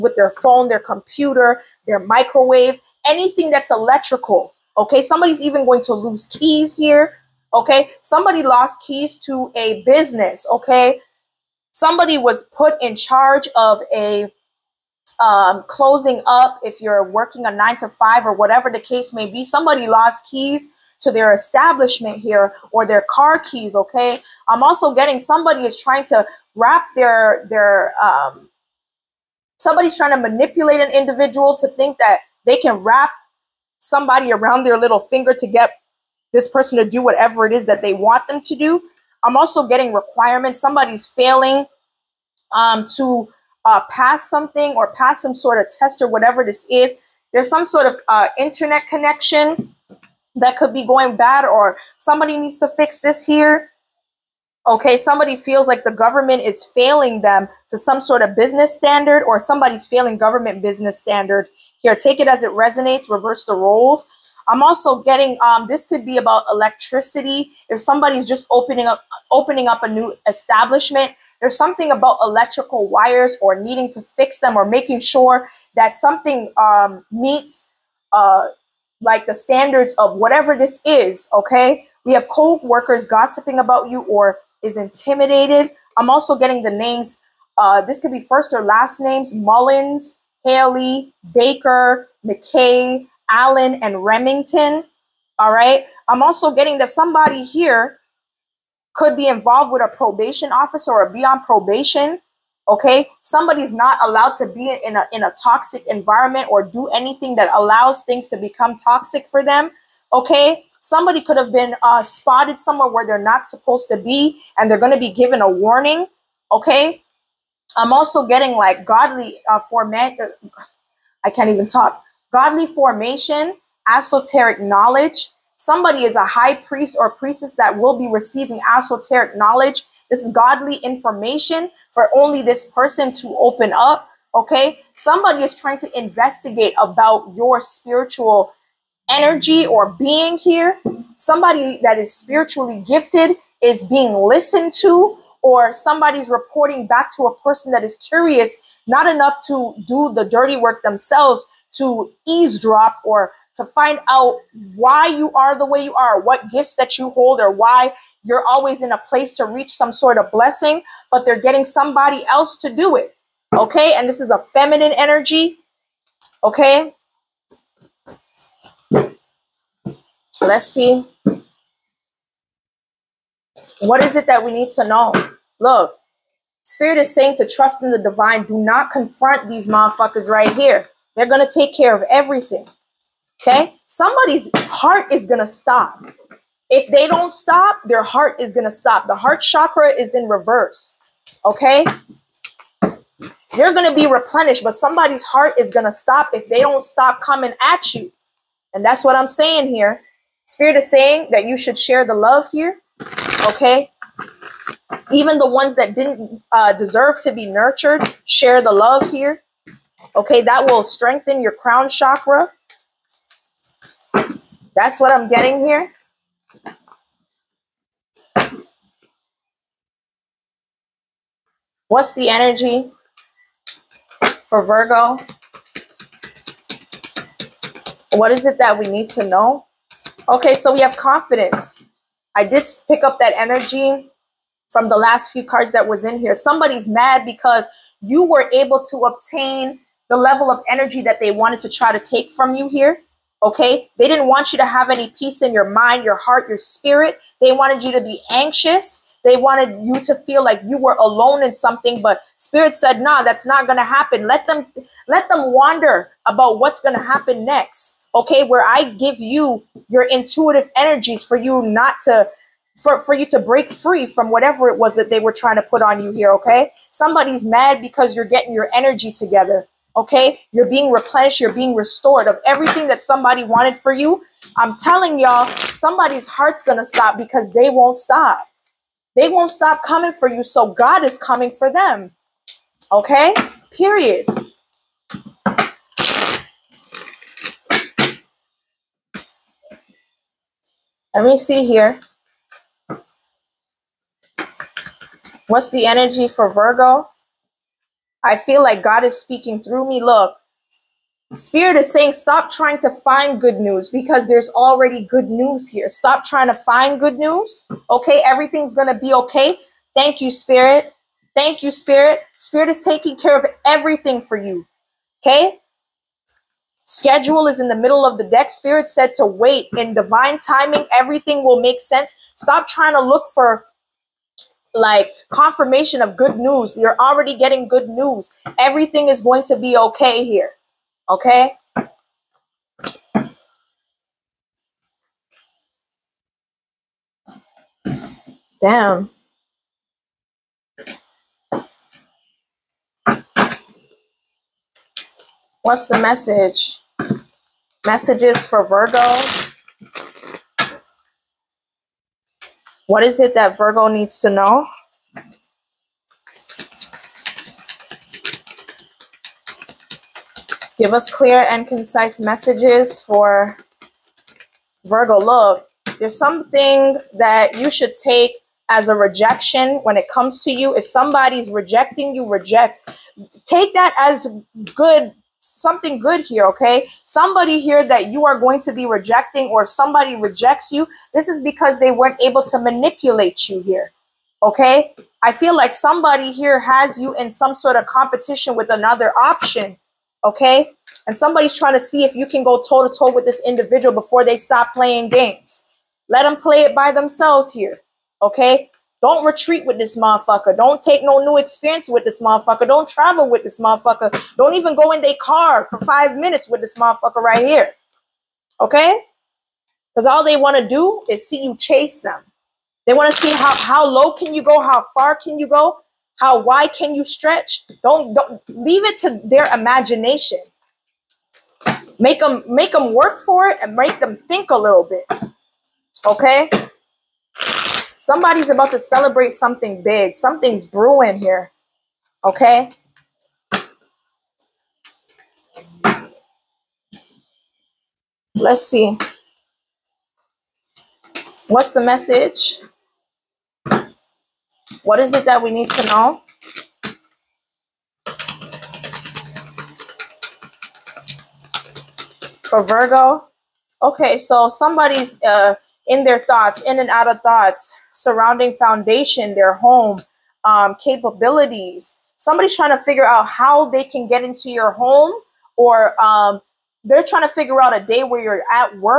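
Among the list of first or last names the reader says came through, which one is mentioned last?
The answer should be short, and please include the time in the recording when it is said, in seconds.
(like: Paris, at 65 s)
Remington, at 94 s.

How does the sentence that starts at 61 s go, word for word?
Here, take it as it resonates, reverse the roles.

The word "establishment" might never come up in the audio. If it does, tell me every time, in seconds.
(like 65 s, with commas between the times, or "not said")
21 s, 70 s.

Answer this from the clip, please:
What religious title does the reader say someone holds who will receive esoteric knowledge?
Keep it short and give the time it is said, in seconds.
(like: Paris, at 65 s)
high priest or priestess, at 126 s.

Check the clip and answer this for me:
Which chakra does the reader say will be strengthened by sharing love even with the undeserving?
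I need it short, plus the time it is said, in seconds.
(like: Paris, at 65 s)
crown chakra, at 211 s.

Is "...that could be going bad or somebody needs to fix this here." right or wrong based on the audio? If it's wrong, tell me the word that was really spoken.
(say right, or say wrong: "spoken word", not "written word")
right.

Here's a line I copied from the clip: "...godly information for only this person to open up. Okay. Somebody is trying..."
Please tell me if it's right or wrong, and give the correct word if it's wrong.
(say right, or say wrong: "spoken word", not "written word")
right.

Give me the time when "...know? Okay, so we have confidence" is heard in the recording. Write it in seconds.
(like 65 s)
229 s.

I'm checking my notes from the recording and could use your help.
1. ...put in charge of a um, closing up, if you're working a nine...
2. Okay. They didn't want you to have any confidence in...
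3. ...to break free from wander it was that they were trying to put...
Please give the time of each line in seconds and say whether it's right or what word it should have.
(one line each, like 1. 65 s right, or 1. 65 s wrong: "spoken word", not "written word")
1. 12 s right
2. 243 s wrong: "peace", not "confidence"
3. 263 s wrong: "whatever", not "wander".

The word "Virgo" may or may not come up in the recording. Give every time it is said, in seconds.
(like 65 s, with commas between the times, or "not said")
224 s, 296 s, 348 s, 353 s, 364 s, 452 s.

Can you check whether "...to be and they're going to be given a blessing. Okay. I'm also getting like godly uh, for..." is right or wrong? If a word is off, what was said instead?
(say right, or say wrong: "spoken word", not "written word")
wrong: "warning", not "blessing".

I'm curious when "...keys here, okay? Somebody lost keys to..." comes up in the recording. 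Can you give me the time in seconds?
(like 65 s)
6 s.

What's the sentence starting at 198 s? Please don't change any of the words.
And that's what I'm saying here.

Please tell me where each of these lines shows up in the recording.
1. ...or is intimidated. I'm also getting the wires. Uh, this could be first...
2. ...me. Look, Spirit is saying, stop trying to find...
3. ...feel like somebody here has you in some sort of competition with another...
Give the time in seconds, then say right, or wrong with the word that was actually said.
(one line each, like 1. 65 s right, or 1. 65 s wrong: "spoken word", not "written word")
1. 84 s wrong: "names", not "wires"
2. 299 s right
3. 385 s right.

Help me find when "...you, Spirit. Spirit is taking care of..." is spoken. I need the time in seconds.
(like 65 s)
311 s.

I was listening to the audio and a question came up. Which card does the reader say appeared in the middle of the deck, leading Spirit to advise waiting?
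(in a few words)
Schedule.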